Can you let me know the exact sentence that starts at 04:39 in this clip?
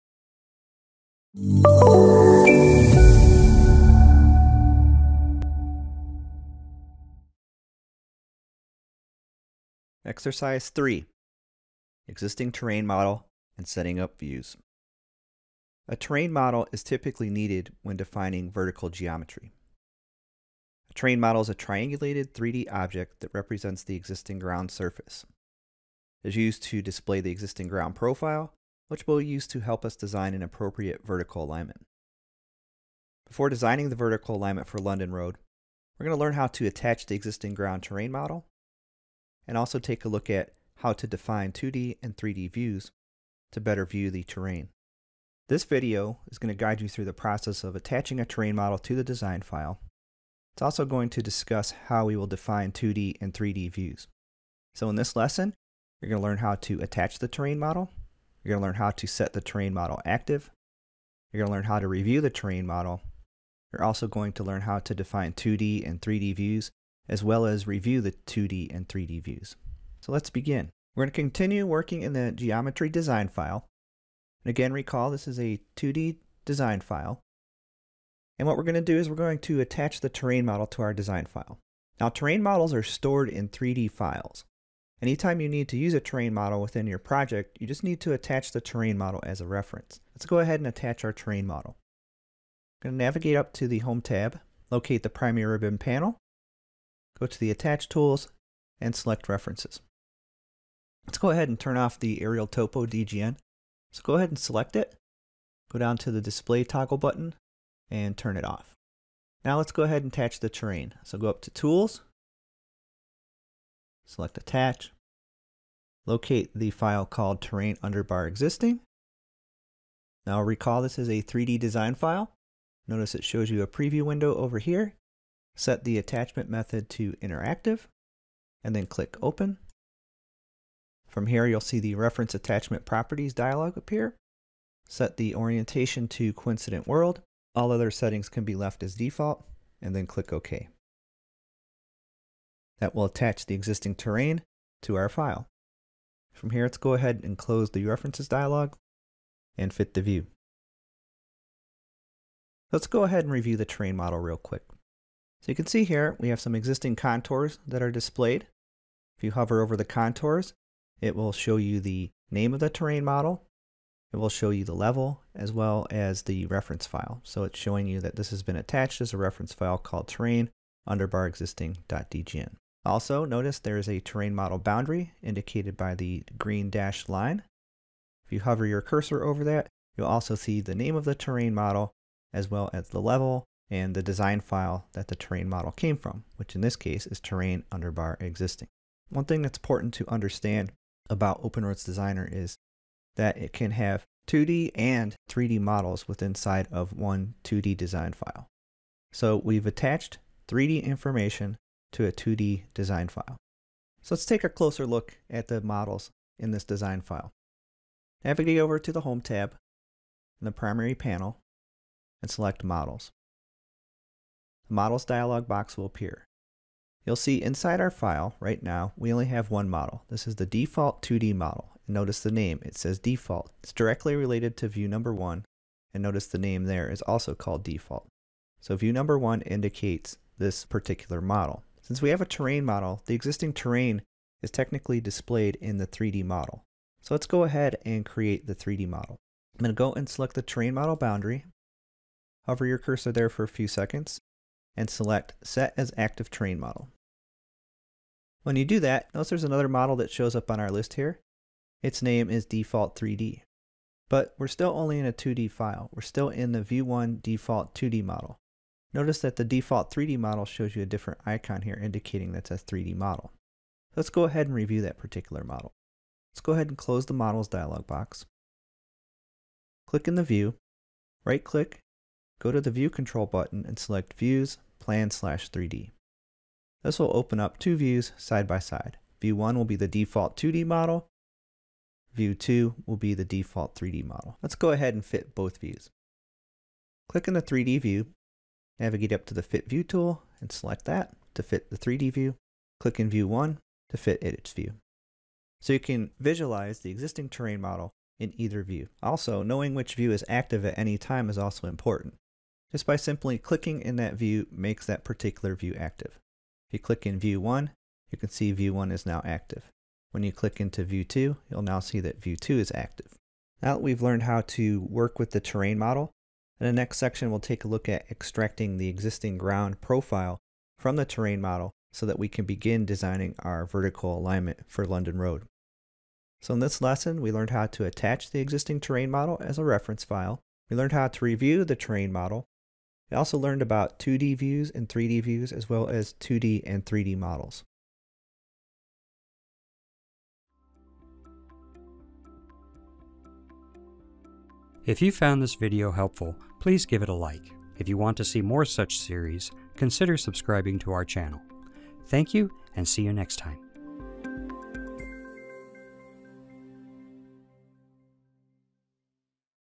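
View 1 will be the default 2D model.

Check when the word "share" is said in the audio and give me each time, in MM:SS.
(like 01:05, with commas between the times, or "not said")
not said.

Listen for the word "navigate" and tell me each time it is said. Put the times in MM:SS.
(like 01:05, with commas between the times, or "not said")
01:33, 03:28, 04:48.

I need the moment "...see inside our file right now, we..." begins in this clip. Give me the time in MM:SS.
03:37.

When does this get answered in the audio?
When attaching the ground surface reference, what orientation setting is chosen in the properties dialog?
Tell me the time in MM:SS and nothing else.
02:16.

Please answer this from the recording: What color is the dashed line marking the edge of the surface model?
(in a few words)
green.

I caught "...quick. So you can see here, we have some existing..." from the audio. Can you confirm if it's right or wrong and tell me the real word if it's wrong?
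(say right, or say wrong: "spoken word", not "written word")
right.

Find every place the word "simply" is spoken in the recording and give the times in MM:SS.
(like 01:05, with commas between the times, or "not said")
05:02.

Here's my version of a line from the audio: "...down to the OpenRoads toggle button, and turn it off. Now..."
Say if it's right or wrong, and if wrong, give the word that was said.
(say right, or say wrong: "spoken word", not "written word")
wrong: "Display", not "OpenRoads".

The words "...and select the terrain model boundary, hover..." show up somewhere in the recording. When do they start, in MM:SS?
03:59.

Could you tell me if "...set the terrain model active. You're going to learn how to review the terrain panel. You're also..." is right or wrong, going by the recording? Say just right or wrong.
wrong.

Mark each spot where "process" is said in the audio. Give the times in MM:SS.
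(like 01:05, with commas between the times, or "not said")
00:47.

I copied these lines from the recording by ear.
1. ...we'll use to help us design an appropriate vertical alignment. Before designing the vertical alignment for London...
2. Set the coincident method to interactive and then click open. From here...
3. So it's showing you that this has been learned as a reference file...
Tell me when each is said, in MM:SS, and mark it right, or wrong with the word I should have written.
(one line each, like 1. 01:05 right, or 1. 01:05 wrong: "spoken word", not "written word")
1. 00:29 right
2. 02:05 wrong: "attachment", not "coincident"
3. 02:47 wrong: "attached", not "learned".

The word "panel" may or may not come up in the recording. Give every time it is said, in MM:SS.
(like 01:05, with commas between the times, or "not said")
01:35, 03:30.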